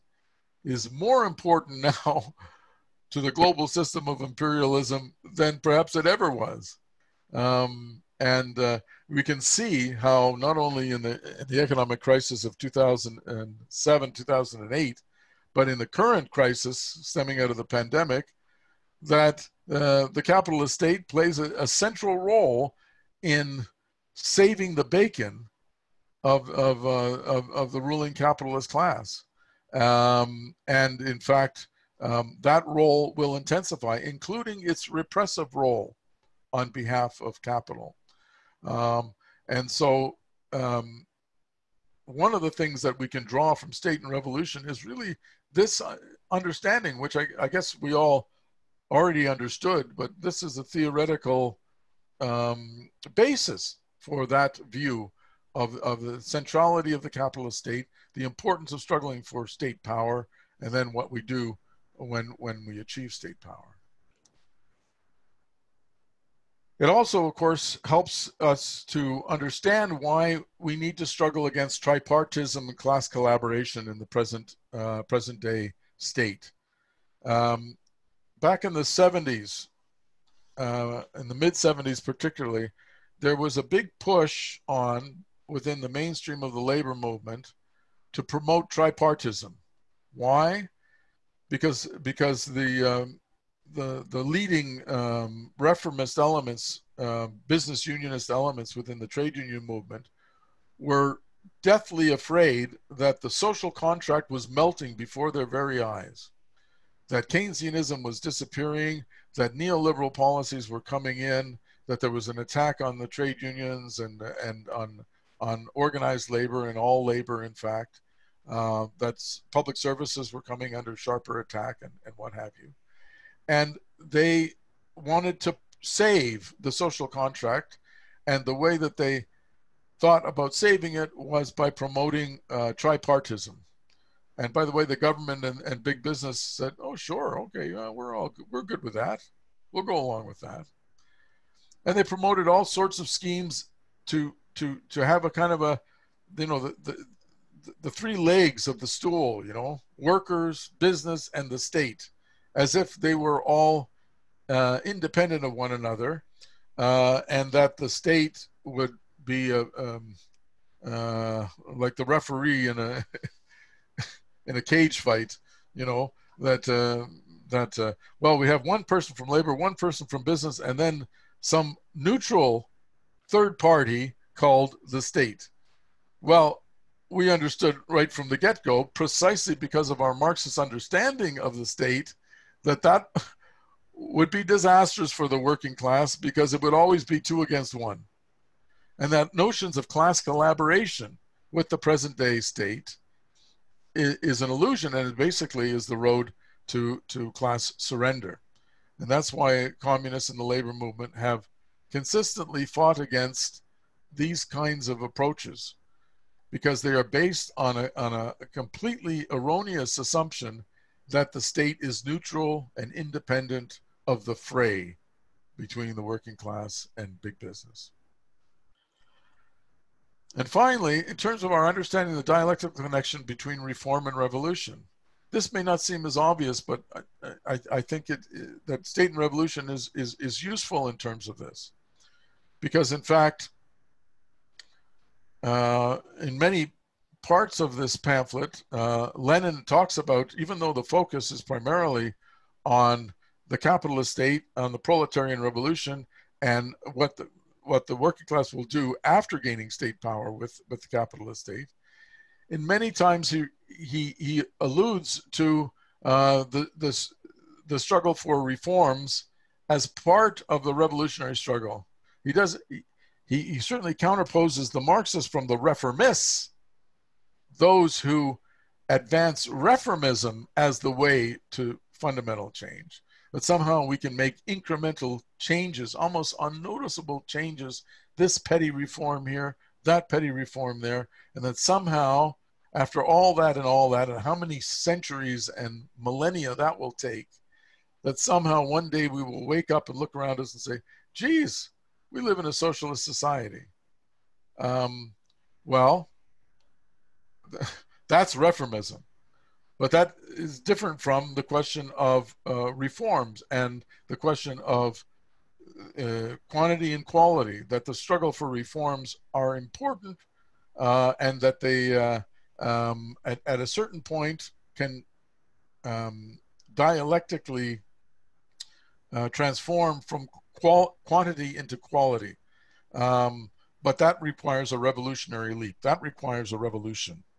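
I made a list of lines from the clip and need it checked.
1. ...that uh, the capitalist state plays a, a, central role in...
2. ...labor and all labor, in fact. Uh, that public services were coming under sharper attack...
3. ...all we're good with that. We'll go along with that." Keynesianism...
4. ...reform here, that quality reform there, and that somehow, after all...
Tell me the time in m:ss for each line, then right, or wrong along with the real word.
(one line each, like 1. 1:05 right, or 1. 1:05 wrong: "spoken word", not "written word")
1. 0:19 right
2. 1:56 right
3. 2:18 wrong: "And", not "Keynesianism"
4. 4:38 wrong: "petty", not "quality".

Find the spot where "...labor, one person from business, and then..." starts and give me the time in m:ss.
2:49.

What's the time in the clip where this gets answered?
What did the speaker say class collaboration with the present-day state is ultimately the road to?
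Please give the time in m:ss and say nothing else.
3:17.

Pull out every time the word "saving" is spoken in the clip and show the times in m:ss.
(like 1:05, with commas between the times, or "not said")
0:24, 2:10.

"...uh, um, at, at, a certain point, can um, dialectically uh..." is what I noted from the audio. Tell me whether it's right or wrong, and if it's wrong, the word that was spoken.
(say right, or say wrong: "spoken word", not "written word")
right.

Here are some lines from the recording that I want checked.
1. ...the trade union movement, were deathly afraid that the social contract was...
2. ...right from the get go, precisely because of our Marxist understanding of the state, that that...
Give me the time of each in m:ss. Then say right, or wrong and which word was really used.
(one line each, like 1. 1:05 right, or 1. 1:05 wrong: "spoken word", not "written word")
1. 1:38 right
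2. 2:57 right.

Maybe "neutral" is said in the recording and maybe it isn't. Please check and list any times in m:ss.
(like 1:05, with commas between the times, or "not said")
2:51, 3:32.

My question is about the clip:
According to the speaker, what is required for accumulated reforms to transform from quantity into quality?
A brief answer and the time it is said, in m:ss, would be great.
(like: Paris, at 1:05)
a revolutionary leap, at 5:24.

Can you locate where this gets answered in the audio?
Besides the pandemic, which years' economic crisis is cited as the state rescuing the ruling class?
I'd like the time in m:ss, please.
0:12.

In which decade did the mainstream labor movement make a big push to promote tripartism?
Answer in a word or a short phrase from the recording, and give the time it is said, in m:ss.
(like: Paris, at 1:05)
the 70s, at 1:18.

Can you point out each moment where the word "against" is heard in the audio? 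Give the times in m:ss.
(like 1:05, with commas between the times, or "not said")
1:11, 3:07, 3:22.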